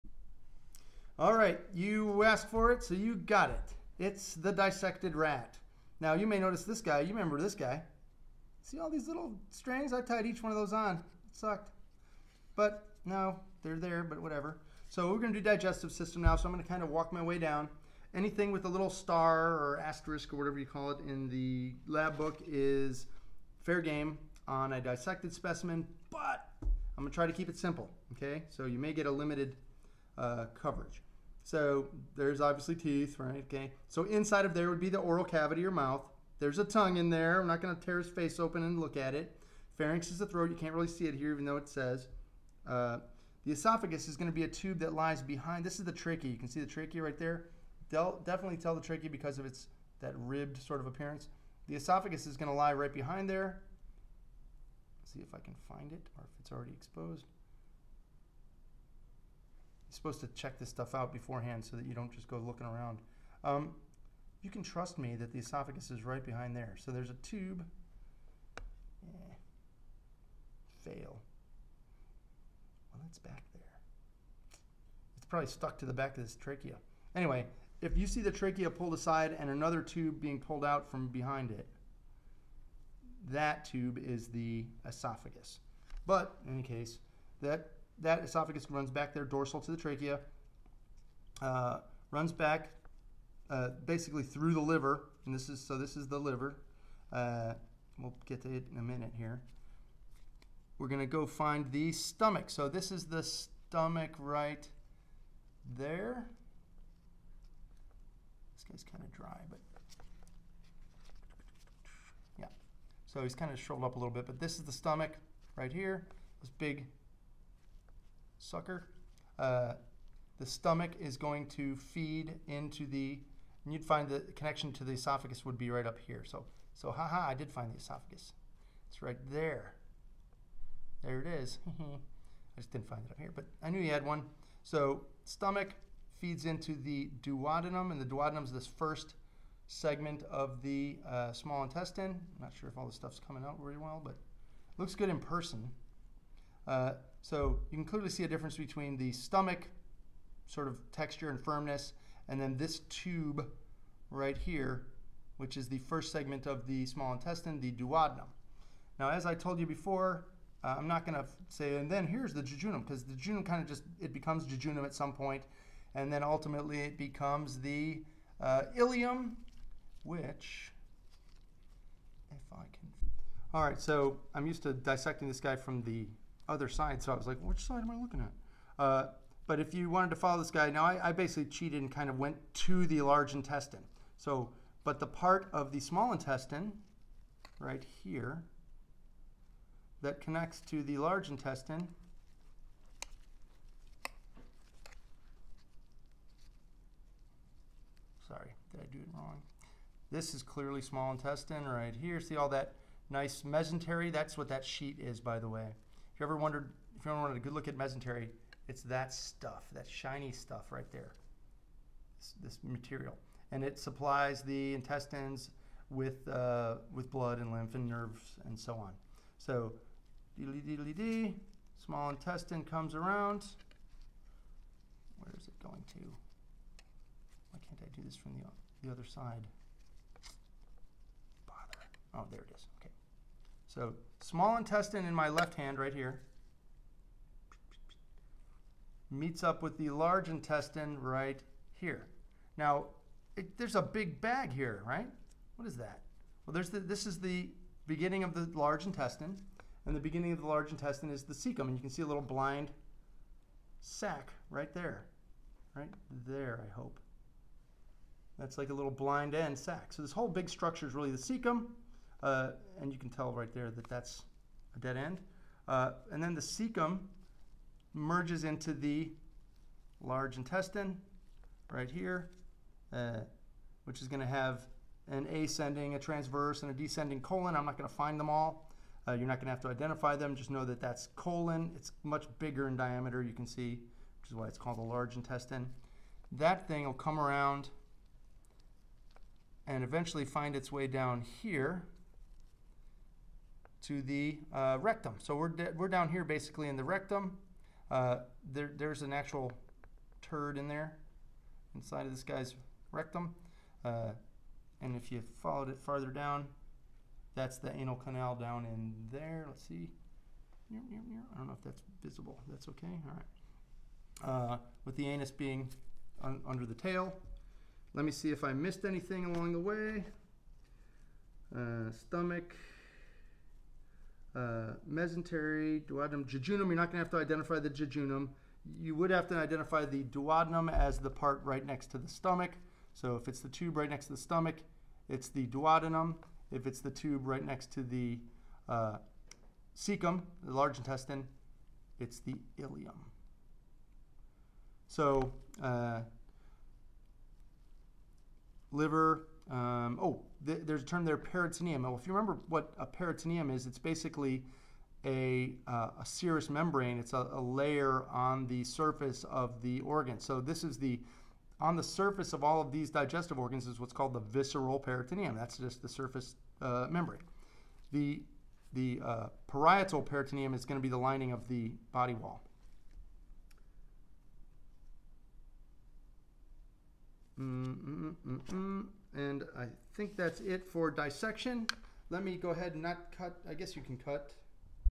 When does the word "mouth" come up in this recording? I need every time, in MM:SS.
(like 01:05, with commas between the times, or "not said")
00:35.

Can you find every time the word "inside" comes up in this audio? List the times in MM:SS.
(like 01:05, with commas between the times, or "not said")
00:34, 05:01.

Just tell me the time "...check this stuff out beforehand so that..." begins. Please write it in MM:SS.
01:00.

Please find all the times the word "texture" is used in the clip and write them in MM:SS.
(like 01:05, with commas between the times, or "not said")
02:30.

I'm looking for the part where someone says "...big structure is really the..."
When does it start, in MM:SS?
04:20.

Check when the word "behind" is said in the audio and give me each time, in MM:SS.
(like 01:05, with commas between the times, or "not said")
00:45, 00:52, 01:06, 01:21.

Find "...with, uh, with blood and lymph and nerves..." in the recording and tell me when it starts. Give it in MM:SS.
03:35.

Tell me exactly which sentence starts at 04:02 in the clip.
Now, it, there's a big bag here, right?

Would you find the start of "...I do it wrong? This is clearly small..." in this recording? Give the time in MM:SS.
03:18.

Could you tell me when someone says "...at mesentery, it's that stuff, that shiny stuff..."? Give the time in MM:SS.
03:27.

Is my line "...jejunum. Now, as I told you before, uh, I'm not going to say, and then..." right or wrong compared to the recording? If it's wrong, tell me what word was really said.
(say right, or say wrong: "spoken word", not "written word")
wrong: "duodenum", not "jejunum".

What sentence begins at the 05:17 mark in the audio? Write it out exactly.
Let me see if I missed anything along the way.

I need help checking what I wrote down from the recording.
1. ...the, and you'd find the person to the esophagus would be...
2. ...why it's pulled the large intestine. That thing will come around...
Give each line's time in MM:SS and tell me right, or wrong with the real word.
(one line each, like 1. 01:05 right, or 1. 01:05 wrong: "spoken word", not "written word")
1. 02:02 wrong: "connection", not "person"
2. 04:44 wrong: "called", not "pulled".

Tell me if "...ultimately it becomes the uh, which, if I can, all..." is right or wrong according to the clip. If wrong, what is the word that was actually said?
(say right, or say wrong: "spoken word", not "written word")
right.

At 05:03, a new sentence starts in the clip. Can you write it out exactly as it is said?
Uh, and if you followed it farther down, that's the anal canal down in there.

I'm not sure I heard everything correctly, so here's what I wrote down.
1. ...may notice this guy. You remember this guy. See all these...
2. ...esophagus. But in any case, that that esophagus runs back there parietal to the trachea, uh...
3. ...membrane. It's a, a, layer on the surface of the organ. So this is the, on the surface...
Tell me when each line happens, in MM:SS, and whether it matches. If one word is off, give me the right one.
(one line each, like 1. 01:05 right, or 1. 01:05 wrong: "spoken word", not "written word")
1. 00:06 right
2. 01:24 wrong: "dorsal", not "parietal"
3. 05:56 right.